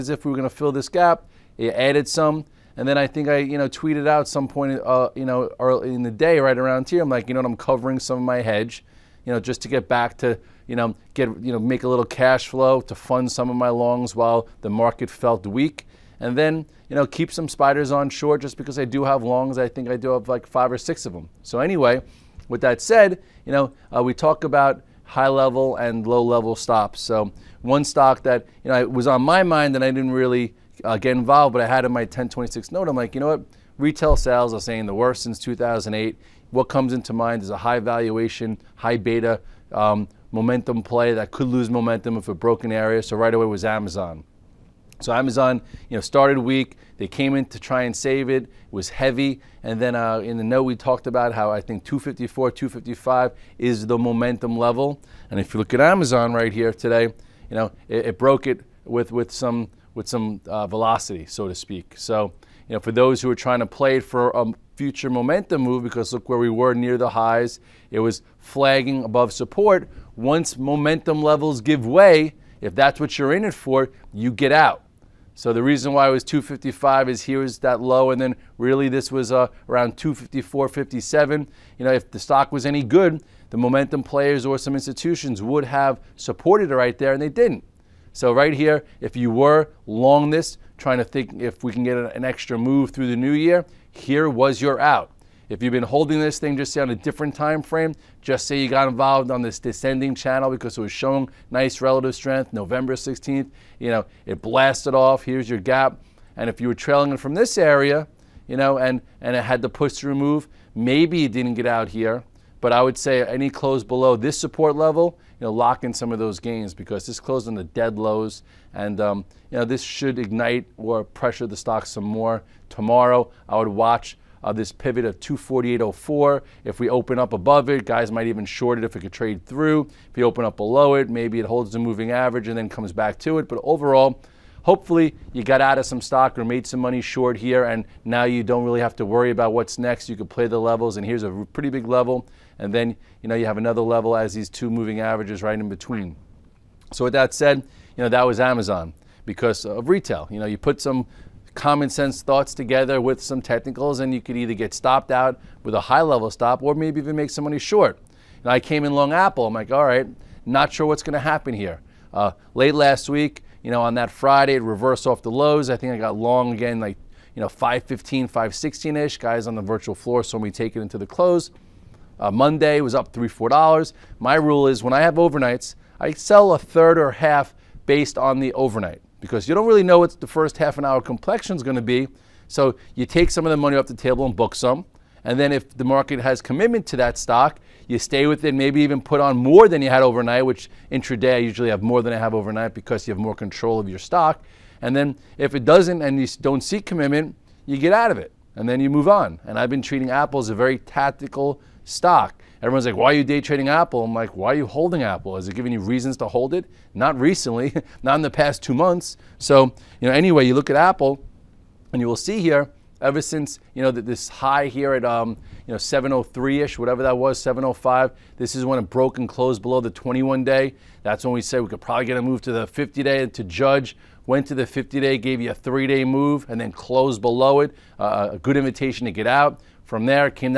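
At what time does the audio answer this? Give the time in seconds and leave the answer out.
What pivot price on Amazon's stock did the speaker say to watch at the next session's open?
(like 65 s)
125 s.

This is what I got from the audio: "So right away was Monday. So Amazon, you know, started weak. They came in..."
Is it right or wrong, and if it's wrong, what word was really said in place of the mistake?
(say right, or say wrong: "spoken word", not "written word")
wrong: "Amazon", not "Monday".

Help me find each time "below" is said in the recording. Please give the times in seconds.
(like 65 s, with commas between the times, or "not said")
113 s, 130 s, 219 s, 227 s.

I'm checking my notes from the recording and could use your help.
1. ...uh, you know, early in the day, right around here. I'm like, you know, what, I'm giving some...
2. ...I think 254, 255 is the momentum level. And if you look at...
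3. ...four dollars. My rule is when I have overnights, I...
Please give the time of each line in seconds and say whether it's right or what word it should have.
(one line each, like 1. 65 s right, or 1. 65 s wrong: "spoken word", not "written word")
1. 4 s wrong: "covering", not "giving"
2. 51 s right
3. 173 s right.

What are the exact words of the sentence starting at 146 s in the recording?
So with that said, you know, that was Amazon because of retail.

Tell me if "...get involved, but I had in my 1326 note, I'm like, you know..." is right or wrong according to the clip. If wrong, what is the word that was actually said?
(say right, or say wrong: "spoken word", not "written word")
wrong: "1026", not "1326".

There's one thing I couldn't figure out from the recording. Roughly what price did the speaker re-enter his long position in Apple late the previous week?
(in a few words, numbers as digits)
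515.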